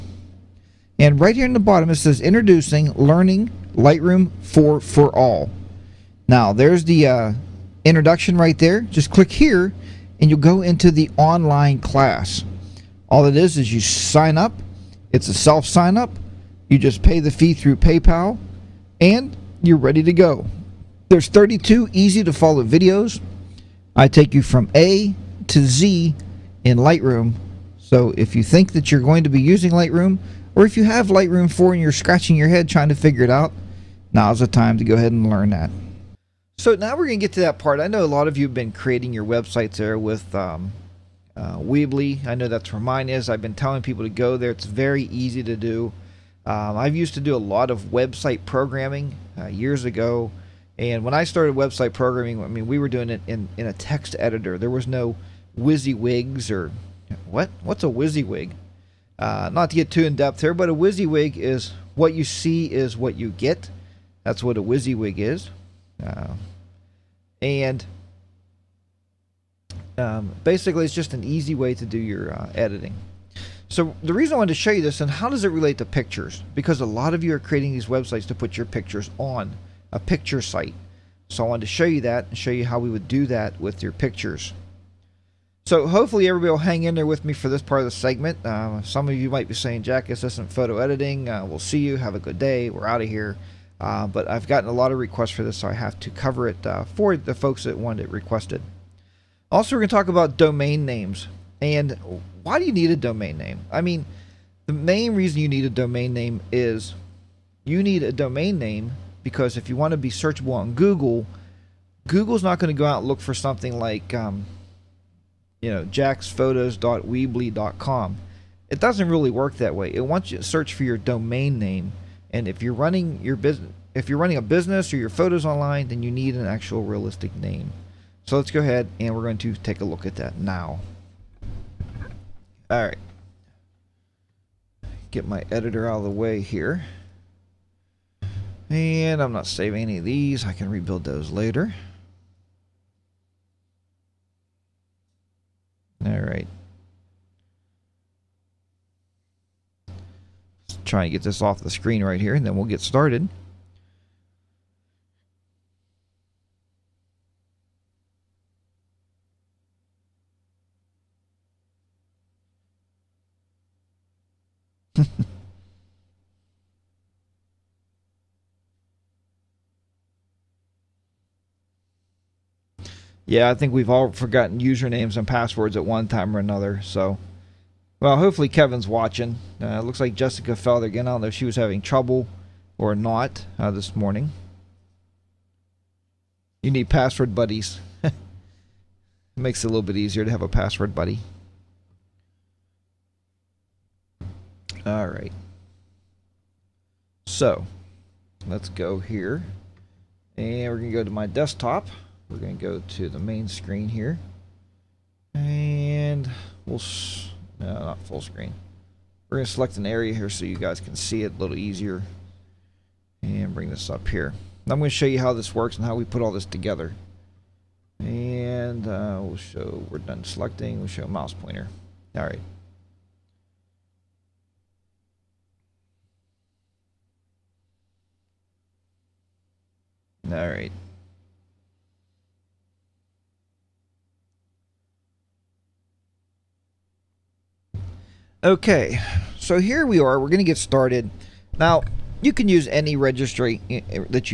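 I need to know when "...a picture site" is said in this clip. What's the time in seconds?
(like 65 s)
79 s.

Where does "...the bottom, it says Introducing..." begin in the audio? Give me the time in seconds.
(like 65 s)
1 s.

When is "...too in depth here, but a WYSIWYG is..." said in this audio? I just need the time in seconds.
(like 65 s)
59 s.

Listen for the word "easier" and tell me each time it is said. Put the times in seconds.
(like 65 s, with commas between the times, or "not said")
189 s, 211 s.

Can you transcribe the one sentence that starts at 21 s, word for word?
There's 32 easy to follow videos.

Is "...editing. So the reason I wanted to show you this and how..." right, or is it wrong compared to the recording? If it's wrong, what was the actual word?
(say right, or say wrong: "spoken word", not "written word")
right.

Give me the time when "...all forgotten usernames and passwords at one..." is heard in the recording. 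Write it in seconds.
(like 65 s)
173 s.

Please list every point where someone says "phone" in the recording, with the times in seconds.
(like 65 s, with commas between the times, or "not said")
not said.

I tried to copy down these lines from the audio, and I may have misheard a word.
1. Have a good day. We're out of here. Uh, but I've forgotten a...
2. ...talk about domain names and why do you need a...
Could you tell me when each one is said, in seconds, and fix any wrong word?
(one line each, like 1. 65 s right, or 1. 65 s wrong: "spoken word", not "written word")
1. 91 s wrong: "gotten", not "forgotten"
2. 99 s right.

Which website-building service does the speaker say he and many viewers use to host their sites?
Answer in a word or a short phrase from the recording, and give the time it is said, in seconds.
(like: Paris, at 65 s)
Weebly, at 41 s.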